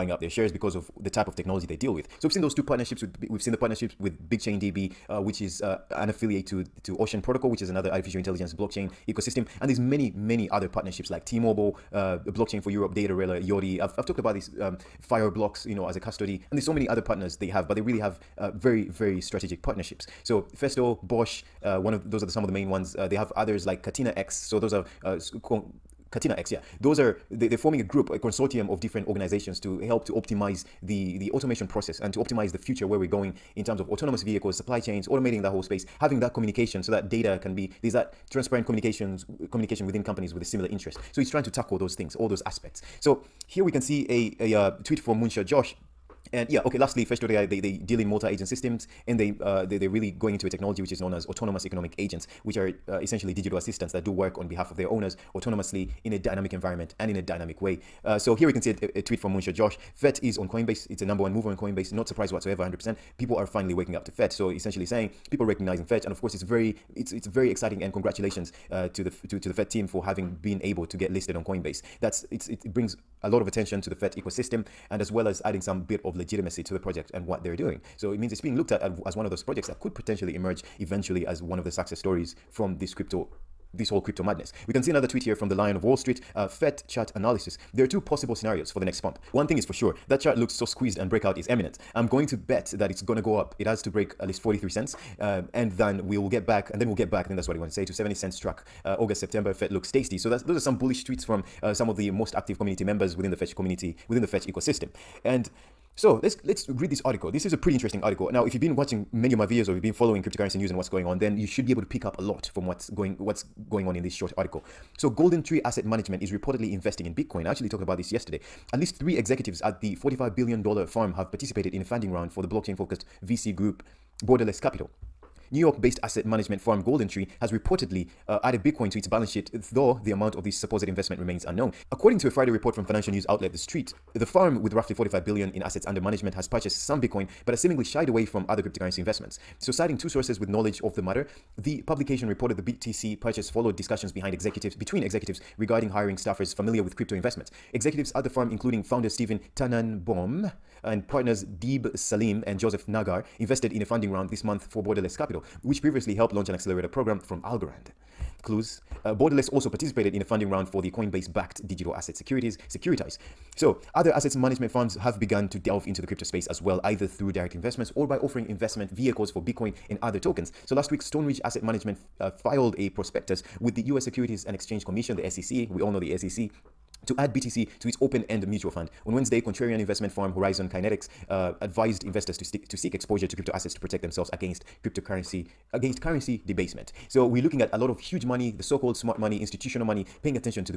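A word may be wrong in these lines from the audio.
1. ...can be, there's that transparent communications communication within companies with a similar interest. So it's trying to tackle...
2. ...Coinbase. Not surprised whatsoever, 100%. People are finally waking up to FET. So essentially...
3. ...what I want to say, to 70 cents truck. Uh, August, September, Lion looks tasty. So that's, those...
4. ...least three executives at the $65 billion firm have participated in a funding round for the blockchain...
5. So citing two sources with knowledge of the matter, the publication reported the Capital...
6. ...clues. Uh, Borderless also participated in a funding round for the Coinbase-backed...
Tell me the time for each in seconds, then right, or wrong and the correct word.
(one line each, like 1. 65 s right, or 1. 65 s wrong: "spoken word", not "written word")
1. 37 s right
2. 61 s right
3. 97 s wrong: "FET", not "Lion"
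4. 118 s wrong: "45", not "65"
5. 139 s wrong: "BTC", not "Capital"
6. 158 s right.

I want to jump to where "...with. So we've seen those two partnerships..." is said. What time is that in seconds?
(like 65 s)
1 s.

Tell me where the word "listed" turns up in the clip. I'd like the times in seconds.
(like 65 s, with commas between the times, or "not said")
71 s.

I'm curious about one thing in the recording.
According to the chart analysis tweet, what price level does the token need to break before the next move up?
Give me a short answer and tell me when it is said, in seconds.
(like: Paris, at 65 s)
43 cents, at 94 s.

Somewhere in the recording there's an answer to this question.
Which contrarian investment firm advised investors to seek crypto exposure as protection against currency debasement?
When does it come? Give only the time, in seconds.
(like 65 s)
180 s.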